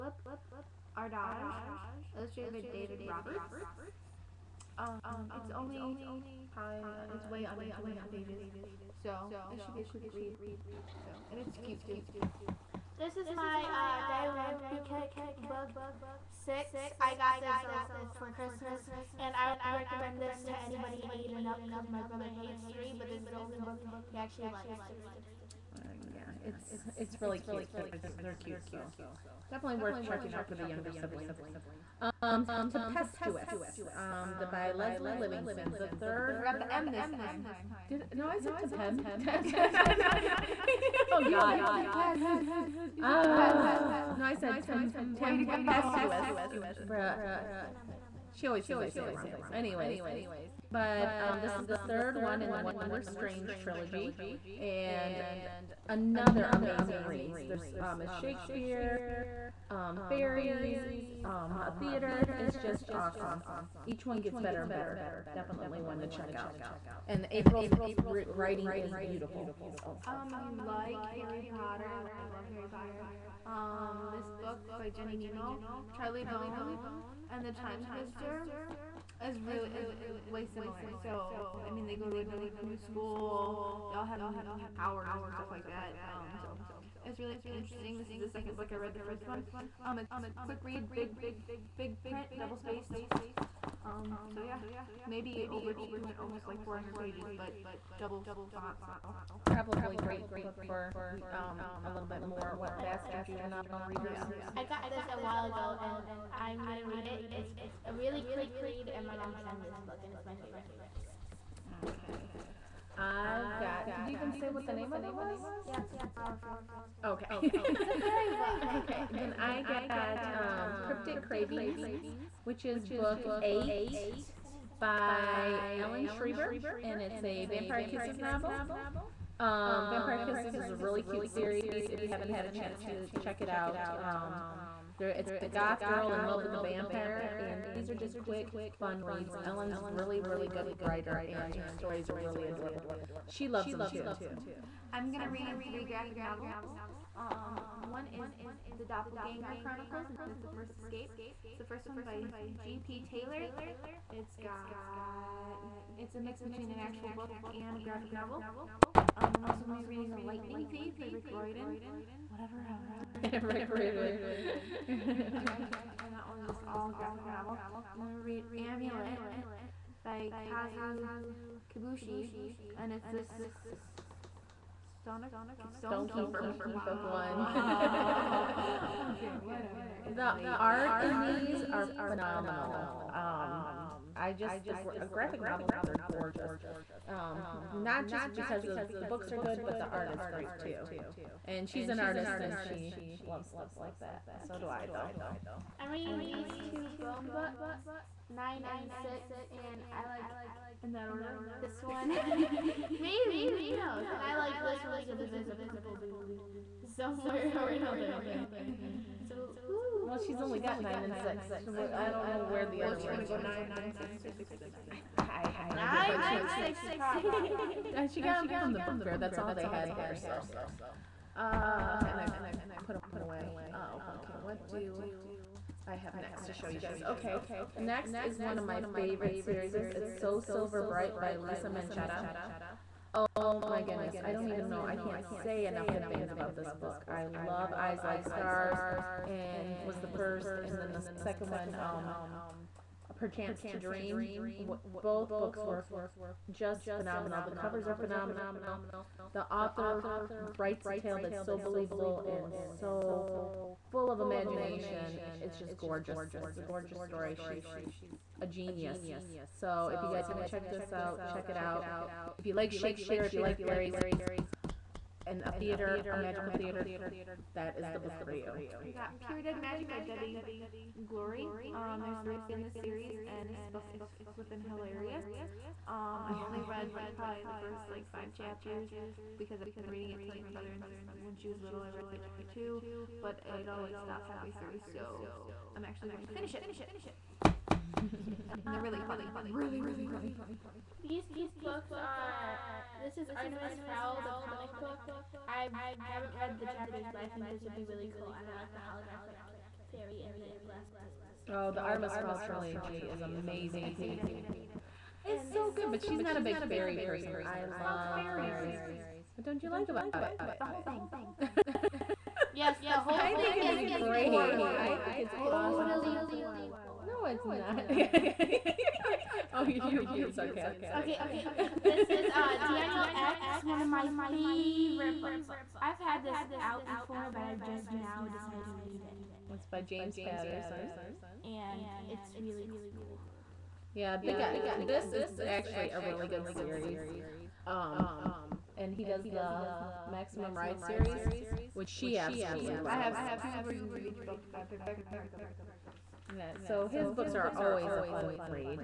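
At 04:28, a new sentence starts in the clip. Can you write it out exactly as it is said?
I got Pure Dead Magic by Debi Gliori.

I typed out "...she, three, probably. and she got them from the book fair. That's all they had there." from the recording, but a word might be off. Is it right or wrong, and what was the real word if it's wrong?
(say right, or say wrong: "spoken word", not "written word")
wrong: "six", not "three".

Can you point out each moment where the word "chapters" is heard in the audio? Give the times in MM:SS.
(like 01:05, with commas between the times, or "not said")
04:38, 04:56.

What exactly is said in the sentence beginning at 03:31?
I don't know where the well, other.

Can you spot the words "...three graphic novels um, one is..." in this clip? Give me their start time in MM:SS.
02:25.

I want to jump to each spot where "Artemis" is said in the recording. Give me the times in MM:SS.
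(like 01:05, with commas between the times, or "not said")
04:53, 05:01.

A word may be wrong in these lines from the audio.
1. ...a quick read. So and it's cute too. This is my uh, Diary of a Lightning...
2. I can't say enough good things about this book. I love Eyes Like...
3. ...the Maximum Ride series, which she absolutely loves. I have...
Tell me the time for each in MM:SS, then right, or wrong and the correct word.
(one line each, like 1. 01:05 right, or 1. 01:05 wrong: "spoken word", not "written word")
1. 00:09 wrong: "Kick", not "Lightning"
2. 03:54 right
3. 05:39 right.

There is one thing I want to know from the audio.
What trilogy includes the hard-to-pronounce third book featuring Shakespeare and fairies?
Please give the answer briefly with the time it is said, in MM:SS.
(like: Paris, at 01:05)
Wondrous Strange, at 00:52.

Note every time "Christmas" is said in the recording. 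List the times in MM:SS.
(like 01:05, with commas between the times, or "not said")
00:18.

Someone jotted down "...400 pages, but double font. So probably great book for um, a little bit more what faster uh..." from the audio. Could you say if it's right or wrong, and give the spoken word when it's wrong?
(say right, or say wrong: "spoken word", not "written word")
right.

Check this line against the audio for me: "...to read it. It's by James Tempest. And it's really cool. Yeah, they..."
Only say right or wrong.
wrong.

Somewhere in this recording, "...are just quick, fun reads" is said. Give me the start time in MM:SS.
02:17.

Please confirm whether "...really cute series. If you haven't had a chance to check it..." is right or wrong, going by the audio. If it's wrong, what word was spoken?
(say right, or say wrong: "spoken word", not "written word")
right.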